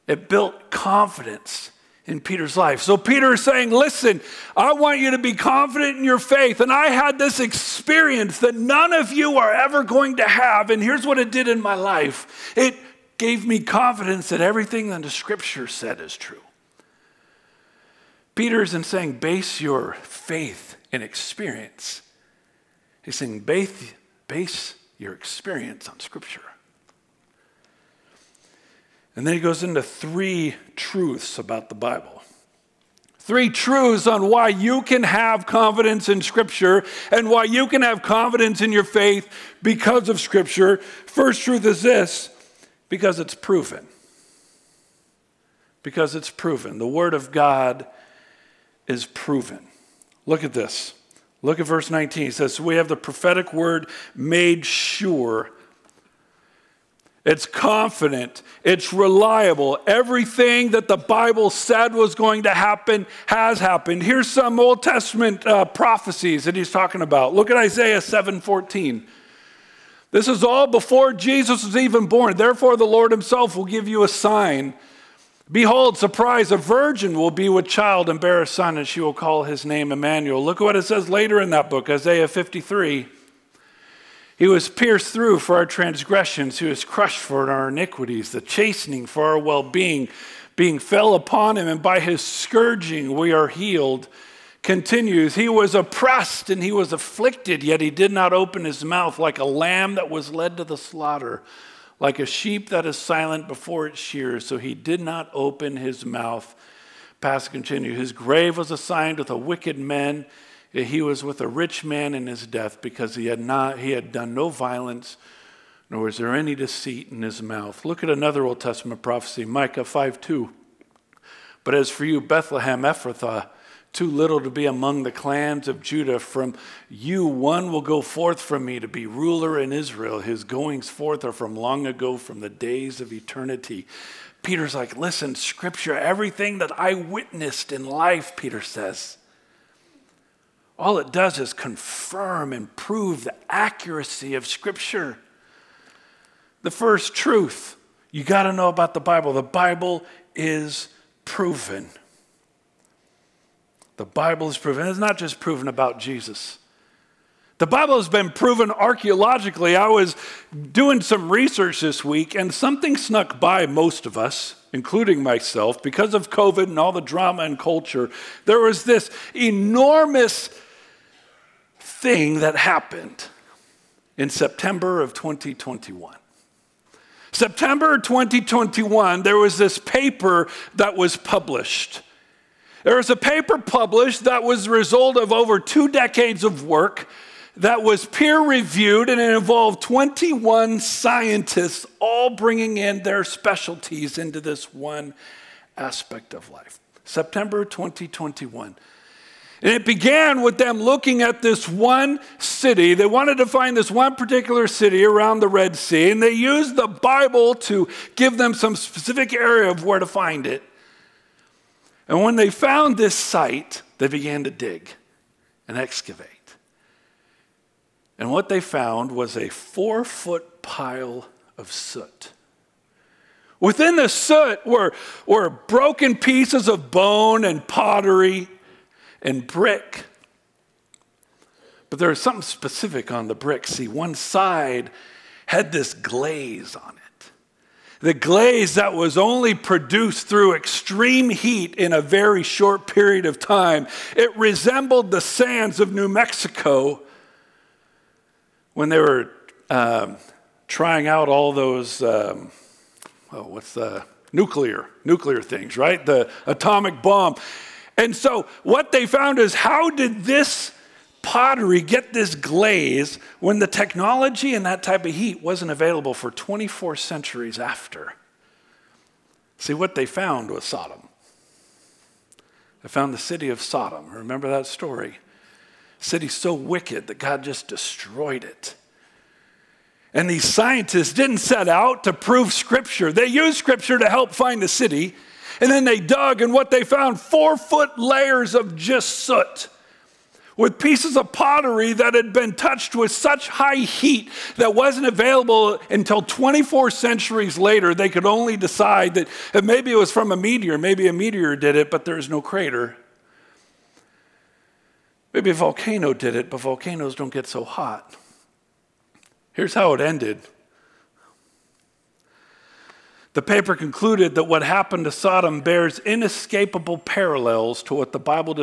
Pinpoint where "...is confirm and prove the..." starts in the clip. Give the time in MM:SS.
02:21.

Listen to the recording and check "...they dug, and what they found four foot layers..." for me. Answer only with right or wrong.
right.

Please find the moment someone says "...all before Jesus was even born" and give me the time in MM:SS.
01:10.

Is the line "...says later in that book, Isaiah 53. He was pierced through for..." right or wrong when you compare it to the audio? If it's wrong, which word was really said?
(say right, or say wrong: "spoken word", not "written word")
right.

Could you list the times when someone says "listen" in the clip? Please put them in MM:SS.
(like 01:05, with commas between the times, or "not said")
00:03, 02:14.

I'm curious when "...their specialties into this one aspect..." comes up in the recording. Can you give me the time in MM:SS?
03:13.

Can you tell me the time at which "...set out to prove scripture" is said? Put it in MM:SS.
04:41.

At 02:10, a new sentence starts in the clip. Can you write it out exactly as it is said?
His goings forth are from long ago, from the days of eternity.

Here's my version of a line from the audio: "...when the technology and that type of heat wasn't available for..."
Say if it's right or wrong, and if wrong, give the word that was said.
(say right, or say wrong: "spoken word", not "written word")
right.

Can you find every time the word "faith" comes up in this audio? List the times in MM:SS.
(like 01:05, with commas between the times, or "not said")
00:06, 00:20, 00:38.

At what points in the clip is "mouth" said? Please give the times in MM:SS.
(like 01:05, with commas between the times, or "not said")
01:38, 01:46, 01:57.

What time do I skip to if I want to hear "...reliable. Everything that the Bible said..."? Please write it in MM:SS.
00:58.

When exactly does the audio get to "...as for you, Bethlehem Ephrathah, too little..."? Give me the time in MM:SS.
02:01.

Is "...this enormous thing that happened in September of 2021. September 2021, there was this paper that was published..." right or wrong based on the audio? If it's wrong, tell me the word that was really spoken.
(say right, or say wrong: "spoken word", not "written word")
right.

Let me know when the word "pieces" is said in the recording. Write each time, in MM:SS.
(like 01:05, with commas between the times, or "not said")
03:46, 04:50.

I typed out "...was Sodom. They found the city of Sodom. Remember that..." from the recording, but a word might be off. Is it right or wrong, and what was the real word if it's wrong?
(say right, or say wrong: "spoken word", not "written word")
right.